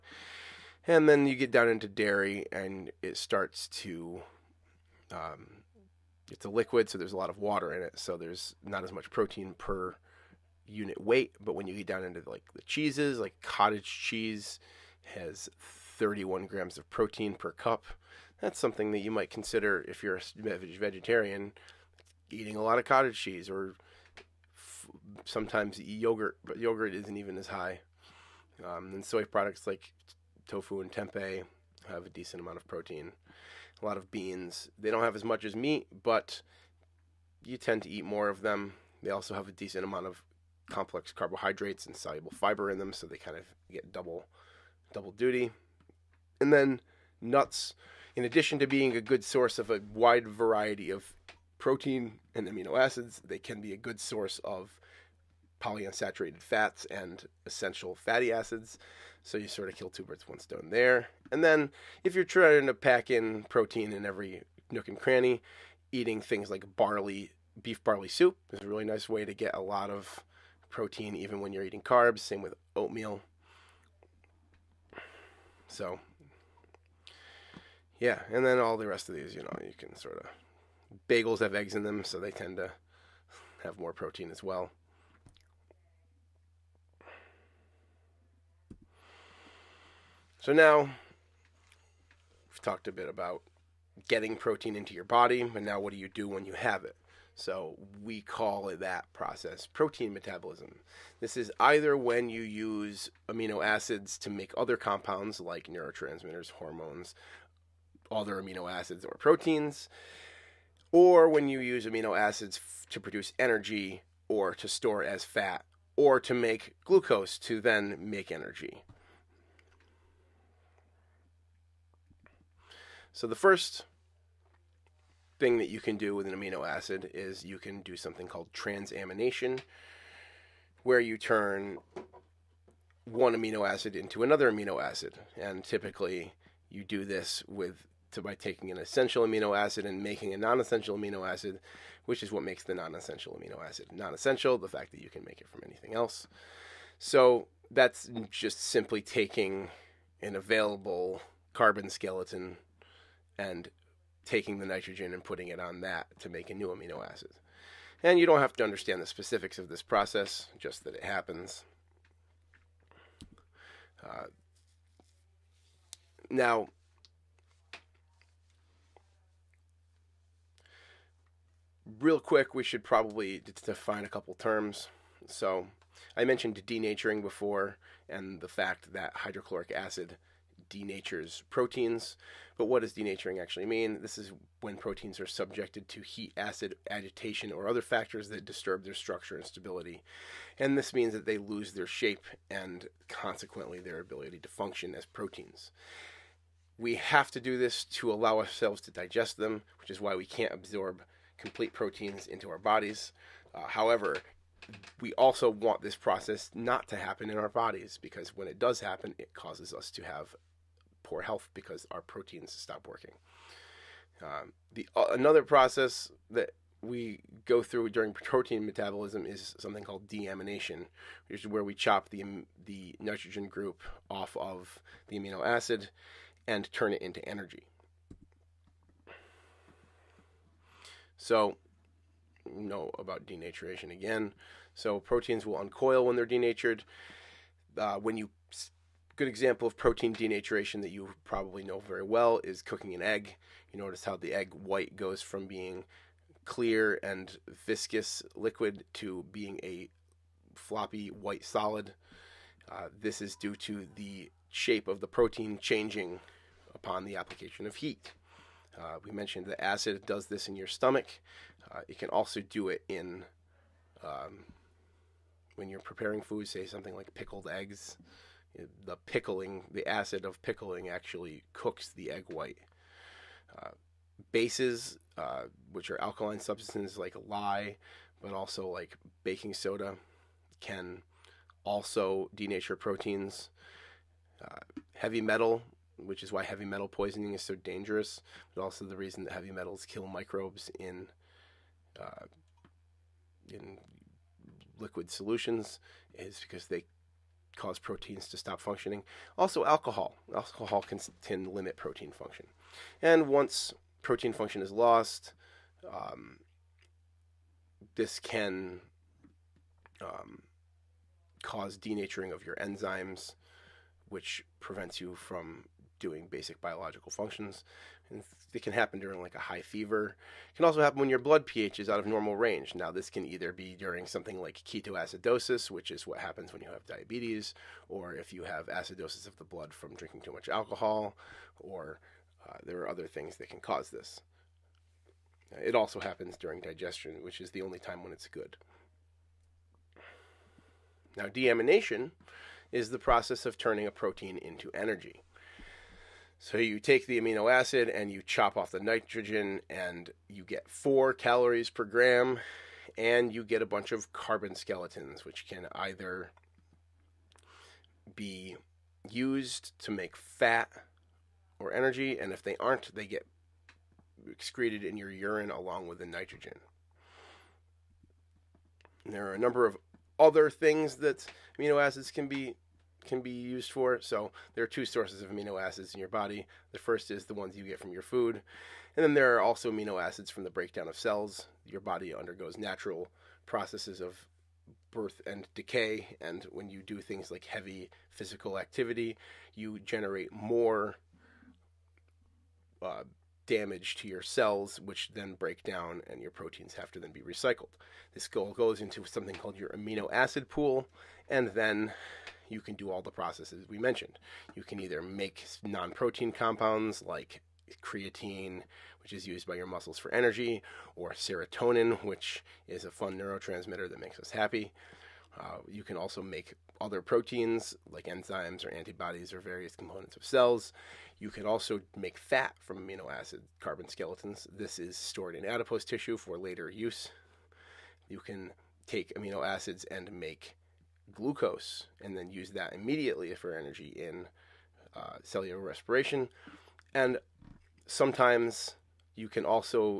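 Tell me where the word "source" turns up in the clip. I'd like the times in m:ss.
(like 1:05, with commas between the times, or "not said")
0:49, 0:53, 6:14.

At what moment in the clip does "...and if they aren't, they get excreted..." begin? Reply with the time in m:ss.
6:02.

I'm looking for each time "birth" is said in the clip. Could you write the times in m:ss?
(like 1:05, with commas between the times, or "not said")
6:24.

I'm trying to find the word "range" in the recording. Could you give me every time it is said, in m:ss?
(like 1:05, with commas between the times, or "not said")
5:22.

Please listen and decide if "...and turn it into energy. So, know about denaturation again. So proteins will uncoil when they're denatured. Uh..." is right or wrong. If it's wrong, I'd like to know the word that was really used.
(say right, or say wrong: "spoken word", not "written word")
right.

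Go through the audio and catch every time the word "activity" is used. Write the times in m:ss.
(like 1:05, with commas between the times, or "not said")
6:28.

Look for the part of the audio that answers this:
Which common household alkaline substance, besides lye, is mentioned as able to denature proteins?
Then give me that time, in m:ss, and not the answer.
4:39.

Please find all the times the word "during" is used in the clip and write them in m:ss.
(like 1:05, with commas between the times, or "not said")
3:37, 5:18, 5:23, 5:36.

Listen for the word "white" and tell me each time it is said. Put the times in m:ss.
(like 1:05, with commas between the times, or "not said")
4:04, 4:11, 4:32.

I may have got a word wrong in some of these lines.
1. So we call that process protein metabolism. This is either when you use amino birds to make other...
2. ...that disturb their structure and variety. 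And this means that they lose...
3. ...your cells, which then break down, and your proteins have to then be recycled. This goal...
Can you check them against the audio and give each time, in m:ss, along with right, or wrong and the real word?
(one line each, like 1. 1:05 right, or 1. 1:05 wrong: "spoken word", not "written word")
1. 1:37 wrong: "acids", not "birds"
2. 3:08 wrong: "stability", not "variety"
3. 6:34 right.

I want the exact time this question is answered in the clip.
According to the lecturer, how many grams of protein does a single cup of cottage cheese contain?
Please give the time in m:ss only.
0:15.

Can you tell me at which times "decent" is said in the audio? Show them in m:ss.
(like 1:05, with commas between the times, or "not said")
0:32, 0:39.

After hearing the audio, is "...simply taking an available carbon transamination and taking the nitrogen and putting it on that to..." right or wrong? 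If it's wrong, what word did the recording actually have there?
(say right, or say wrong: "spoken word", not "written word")
wrong: "skeleton", not "transamination".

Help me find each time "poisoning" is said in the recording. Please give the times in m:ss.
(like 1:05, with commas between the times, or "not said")
4:46.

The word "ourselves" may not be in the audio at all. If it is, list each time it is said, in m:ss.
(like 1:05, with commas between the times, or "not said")
3:18.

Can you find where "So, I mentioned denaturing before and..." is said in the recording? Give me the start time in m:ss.
2:55.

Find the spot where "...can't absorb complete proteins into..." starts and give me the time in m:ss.
3:20.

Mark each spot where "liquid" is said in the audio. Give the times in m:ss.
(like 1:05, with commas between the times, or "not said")
0:06, 4:08, 4:54.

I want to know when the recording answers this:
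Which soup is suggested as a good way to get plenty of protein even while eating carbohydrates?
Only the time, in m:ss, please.
1:07.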